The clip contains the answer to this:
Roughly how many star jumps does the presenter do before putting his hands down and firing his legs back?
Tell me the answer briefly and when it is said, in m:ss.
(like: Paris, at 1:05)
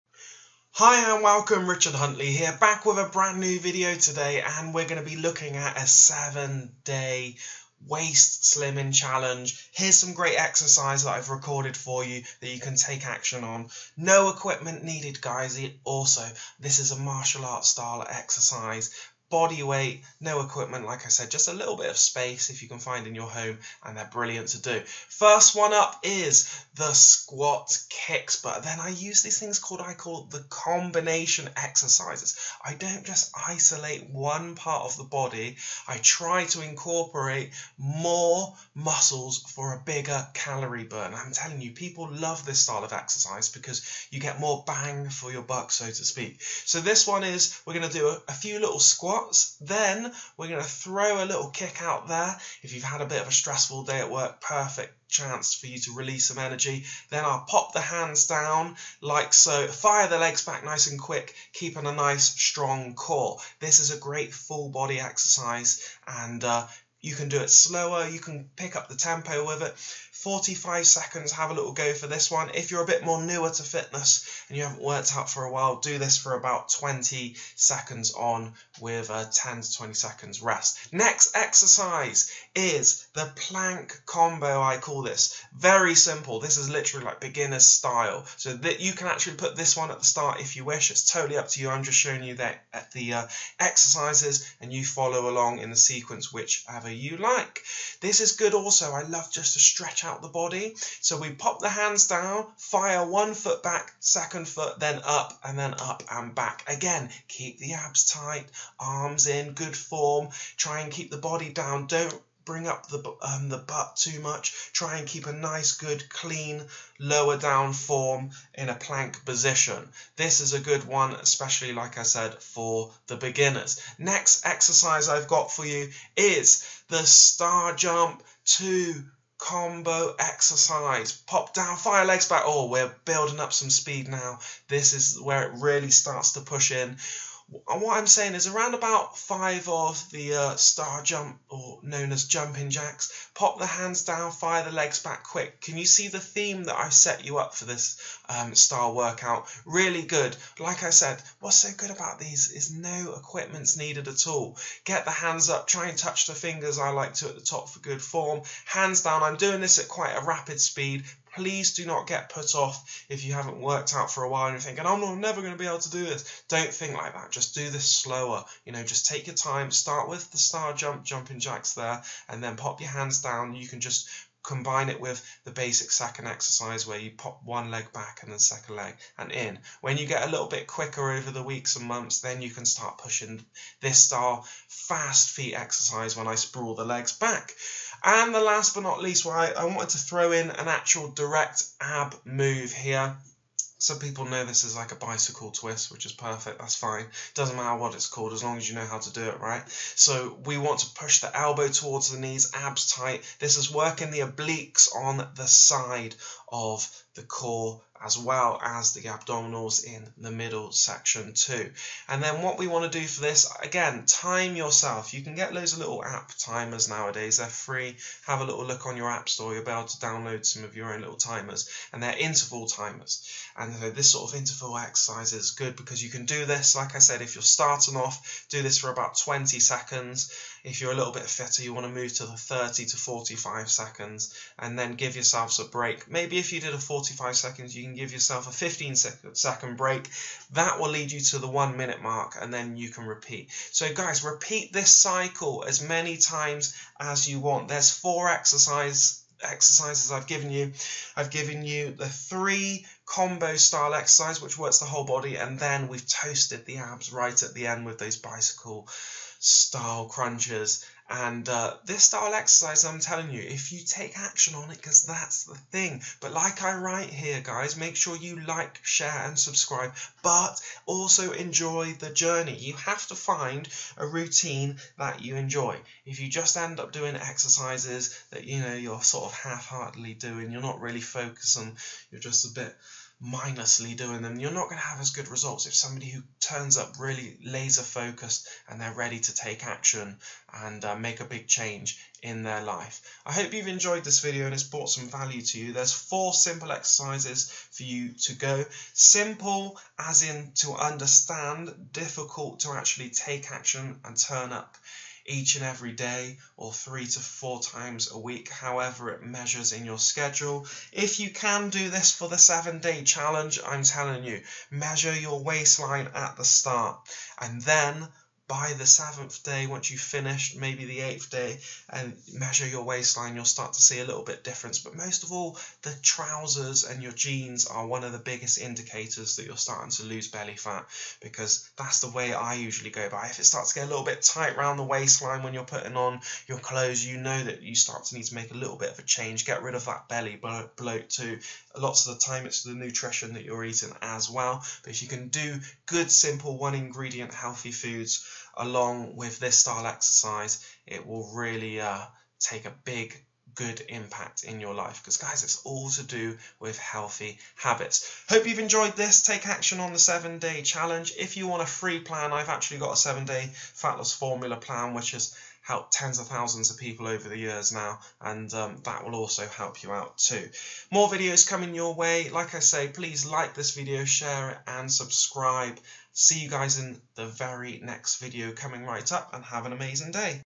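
5, at 2:19.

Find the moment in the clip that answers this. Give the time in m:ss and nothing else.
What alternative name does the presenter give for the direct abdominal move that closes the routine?
3:14.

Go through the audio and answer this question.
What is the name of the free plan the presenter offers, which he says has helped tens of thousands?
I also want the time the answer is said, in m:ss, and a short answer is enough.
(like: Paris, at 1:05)
seven day fat loss formula, at 6:02.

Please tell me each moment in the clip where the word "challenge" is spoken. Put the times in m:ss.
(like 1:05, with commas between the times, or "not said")
0:08, 5:13, 6:00.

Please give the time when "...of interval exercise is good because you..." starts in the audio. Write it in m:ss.
3:44.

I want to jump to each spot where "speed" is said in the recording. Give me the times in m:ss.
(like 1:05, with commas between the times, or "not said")
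2:13, 2:40.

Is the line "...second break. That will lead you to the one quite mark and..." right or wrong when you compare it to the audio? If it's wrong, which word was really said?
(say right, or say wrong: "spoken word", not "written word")
wrong: "minute", not "quite".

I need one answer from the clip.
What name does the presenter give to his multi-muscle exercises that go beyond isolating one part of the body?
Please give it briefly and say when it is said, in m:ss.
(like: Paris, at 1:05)
combination exercises, at 0:30.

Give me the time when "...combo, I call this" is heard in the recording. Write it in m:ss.
1:24.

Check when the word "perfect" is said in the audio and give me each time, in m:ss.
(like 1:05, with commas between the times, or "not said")
0:54, 3:16.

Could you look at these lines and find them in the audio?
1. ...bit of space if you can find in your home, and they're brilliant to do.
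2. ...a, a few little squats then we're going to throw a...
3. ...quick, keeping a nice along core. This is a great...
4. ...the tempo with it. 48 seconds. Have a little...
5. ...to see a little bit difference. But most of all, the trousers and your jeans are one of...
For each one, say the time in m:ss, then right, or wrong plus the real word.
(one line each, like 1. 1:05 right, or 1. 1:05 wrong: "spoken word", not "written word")
1. 0:21 right
2. 0:48 right
3. 1:00 wrong: "strong", not "along"
4. 1:08 wrong: "45", not "48"
5. 5:23 right.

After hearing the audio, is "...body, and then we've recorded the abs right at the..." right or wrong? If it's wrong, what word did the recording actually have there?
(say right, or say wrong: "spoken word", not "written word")
wrong: "toasted", not "recorded".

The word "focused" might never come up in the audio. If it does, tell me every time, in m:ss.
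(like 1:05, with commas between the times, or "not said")
4:41, 4:47.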